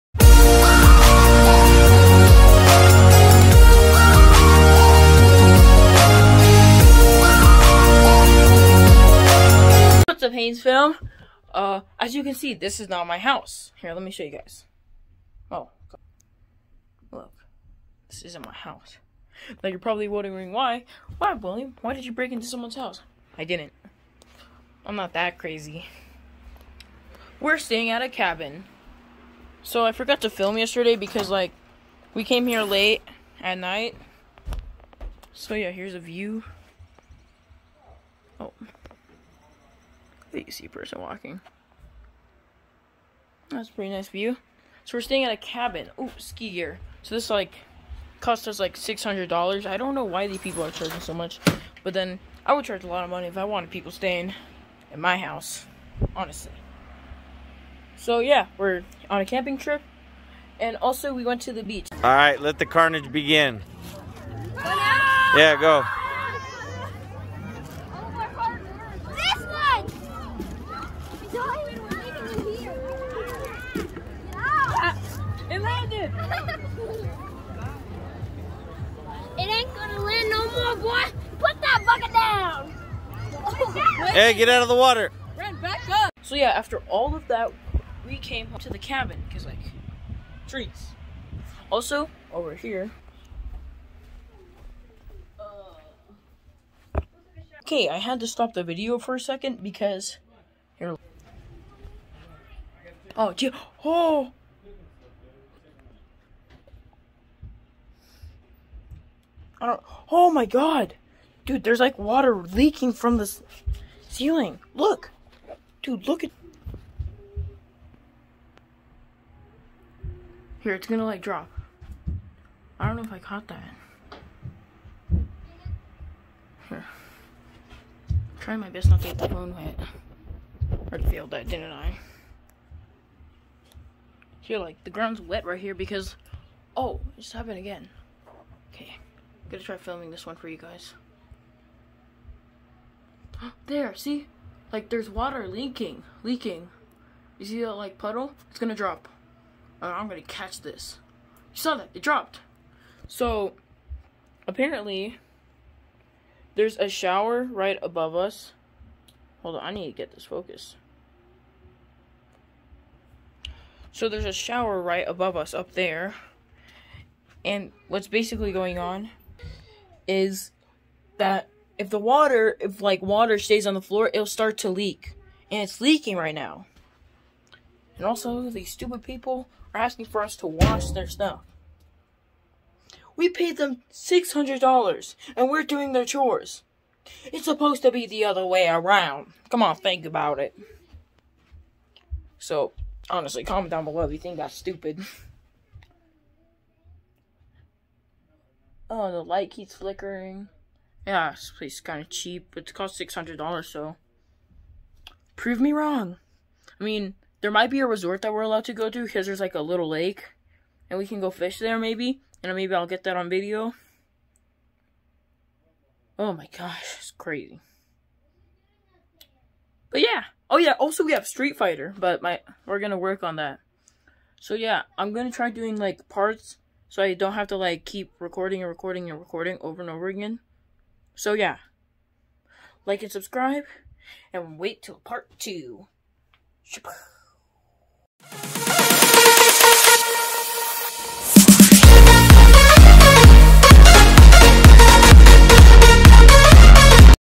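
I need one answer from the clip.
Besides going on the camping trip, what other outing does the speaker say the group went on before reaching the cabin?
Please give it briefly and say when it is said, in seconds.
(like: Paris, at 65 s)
the beach, at 61 s.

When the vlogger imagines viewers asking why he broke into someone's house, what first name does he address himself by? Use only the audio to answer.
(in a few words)
William.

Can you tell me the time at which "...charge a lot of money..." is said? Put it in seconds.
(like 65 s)
52 s.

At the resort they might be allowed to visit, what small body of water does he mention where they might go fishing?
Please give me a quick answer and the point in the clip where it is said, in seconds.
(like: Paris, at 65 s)
a little lake, at 209 s.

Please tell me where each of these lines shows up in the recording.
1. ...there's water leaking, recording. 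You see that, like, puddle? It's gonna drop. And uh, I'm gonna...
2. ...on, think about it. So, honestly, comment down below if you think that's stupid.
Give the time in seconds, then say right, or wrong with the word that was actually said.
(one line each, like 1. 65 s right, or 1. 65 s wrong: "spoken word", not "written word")
1. 144 s wrong: "leaking", not "recording"
2. 189 s right.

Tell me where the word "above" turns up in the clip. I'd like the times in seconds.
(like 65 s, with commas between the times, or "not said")
157 s, 165 s.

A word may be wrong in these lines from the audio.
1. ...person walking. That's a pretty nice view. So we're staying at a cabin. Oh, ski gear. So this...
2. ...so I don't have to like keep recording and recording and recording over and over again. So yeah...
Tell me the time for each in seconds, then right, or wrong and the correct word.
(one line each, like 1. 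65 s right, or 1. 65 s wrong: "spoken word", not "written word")
1. 40 s right
2. 226 s right.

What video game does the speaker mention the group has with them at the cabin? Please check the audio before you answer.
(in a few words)
Street Fighter.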